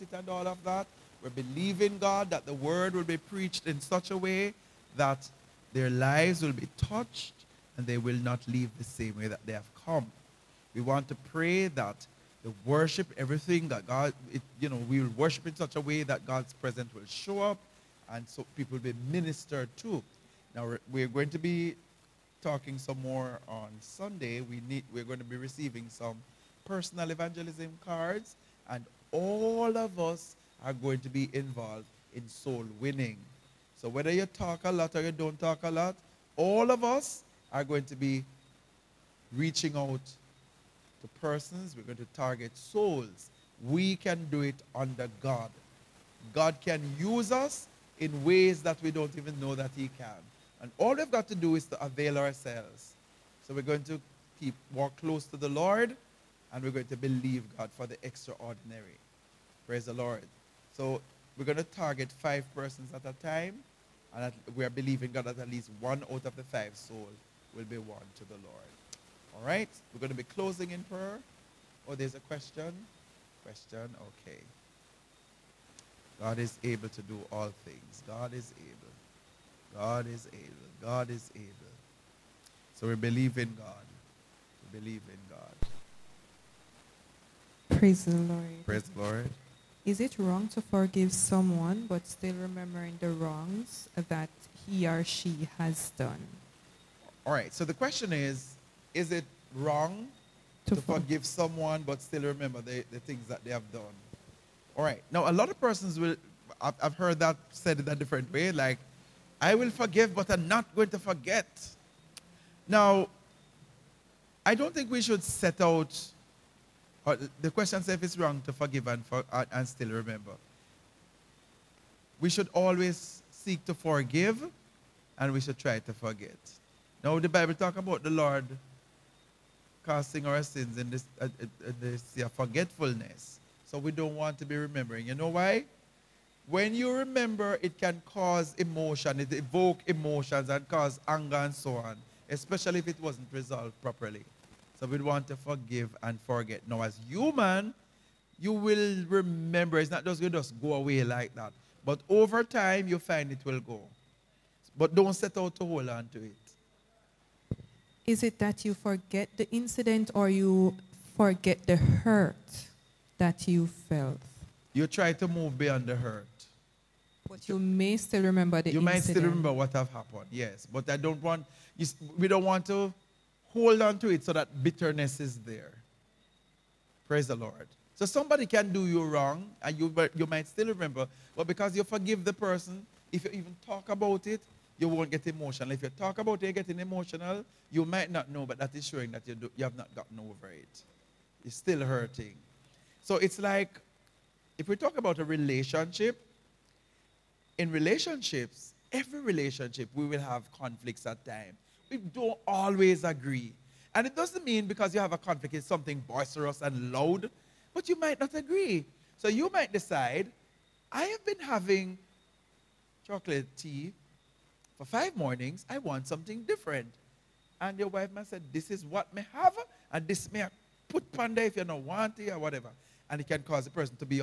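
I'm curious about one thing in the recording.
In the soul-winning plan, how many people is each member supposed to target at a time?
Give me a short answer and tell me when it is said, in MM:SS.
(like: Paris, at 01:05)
5, at 01:02.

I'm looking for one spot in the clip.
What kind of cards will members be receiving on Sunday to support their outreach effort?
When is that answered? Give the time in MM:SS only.
00:26.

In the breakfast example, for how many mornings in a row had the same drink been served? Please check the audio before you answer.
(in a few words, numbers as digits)
5.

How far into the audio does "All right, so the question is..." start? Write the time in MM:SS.
01:37.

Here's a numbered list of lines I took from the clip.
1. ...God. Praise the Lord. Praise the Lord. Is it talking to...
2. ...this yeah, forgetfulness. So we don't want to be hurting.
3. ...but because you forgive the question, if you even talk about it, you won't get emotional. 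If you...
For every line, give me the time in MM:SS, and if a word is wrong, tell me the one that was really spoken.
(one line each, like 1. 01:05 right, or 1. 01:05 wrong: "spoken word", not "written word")
1. 01:25 wrong: "wrong", not "talking"
2. 02:11 wrong: "remembering", not "hurting"
3. 03:01 wrong: "person", not "question".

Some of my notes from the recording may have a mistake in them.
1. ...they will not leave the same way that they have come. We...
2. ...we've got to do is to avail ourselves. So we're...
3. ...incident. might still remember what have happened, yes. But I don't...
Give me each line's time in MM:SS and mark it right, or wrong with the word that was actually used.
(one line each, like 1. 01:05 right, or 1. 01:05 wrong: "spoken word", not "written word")
1. 00:07 right
2. 00:50 right
3. 02:48 right.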